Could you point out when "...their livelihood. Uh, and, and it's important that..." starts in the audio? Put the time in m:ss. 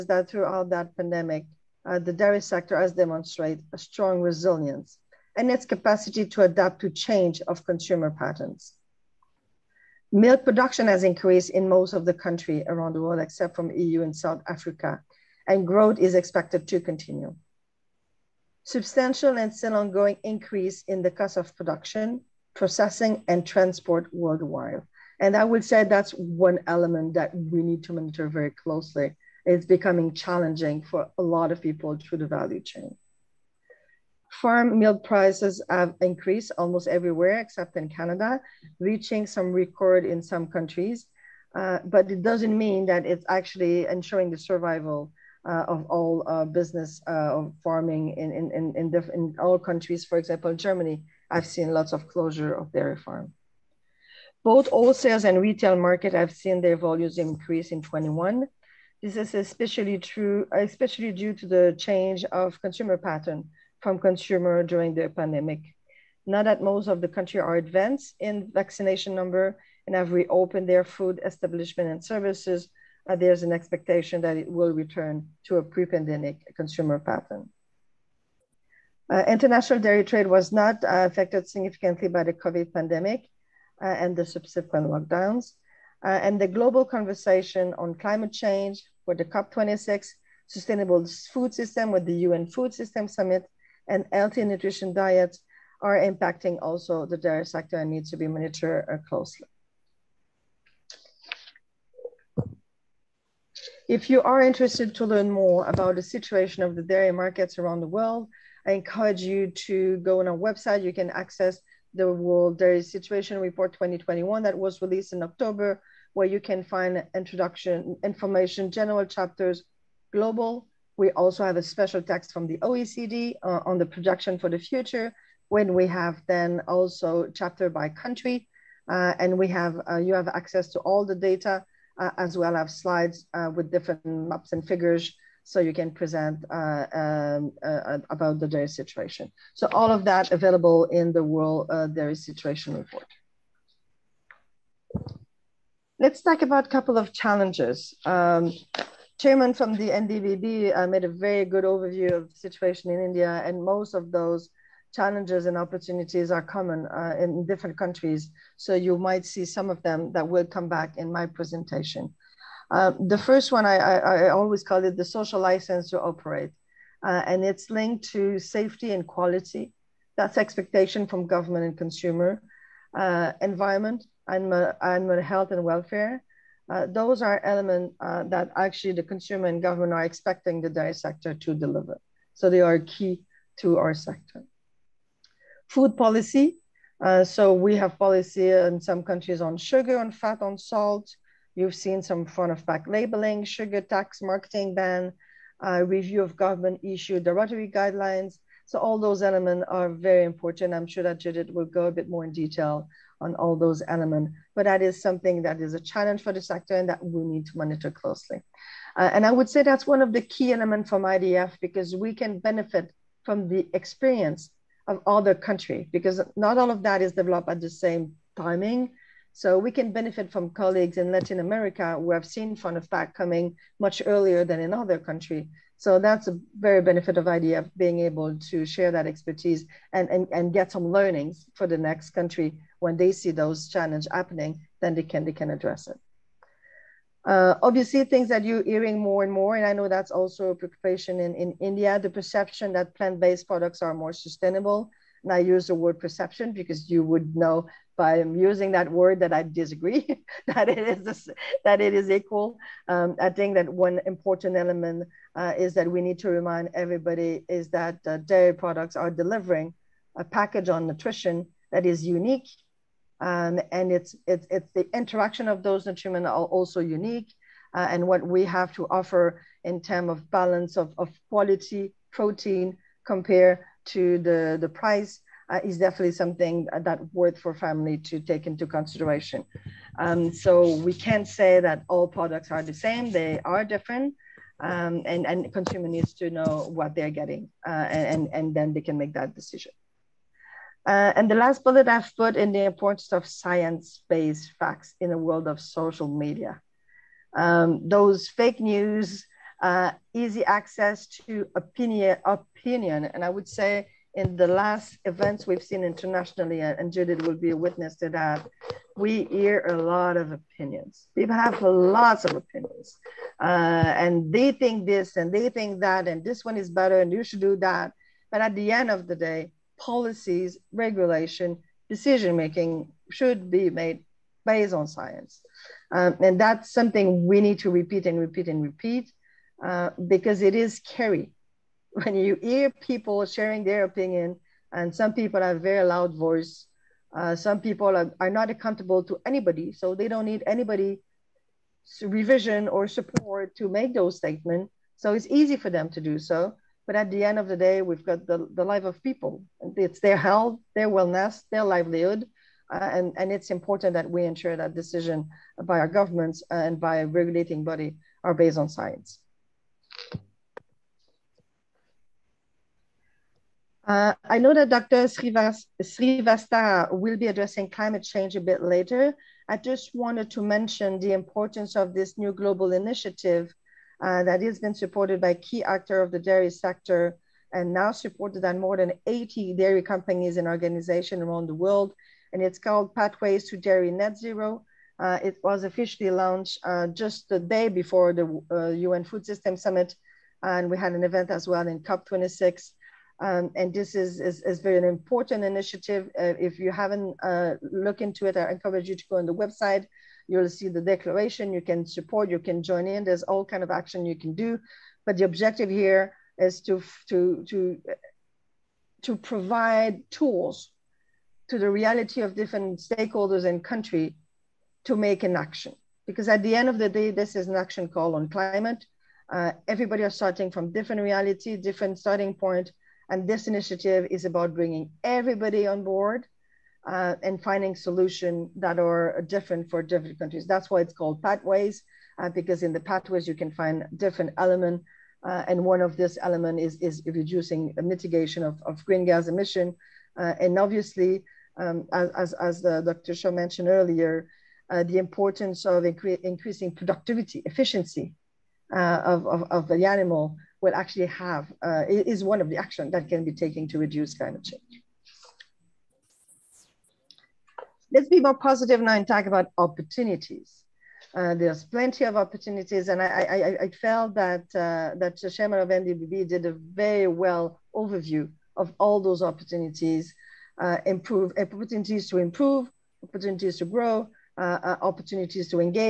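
5:51.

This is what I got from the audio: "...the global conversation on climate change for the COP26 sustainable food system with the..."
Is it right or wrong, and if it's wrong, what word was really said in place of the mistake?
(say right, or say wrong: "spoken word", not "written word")
right.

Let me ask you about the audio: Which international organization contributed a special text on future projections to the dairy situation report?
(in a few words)
OECD.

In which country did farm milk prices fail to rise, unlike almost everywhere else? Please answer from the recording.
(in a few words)
Canada.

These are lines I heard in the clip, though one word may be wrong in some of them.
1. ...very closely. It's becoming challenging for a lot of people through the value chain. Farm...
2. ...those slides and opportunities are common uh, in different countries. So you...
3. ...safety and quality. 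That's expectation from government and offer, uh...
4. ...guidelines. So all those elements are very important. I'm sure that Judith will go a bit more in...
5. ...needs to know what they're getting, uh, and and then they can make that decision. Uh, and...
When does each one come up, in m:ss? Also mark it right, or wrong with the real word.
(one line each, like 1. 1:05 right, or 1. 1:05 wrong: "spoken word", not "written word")
1. 0:28 right
2. 2:34 wrong: "challenges", not "slides"
3. 2:48 wrong: "consumer", not "offer"
4. 3:17 right
5. 4:45 right.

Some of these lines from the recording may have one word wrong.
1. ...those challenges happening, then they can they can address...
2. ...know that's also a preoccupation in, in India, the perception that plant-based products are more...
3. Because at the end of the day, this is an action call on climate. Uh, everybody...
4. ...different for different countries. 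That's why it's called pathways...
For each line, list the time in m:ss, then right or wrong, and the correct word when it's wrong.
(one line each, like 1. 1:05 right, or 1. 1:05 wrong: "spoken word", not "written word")
1. 3:53 right
2. 3:59 right
3. 6:56 right
4. 7:09 right.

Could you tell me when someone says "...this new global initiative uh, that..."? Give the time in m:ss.
6:11.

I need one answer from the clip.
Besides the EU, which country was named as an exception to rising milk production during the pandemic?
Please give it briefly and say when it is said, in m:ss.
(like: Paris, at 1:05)
South Africa, at 0:14.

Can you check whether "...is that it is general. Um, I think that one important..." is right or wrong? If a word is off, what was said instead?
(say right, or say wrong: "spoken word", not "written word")
wrong: "equal", not "general".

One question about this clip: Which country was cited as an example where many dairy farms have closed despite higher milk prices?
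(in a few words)
Germany.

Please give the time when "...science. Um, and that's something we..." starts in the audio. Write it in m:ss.
5:24.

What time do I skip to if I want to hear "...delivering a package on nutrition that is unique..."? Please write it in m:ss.
4:19.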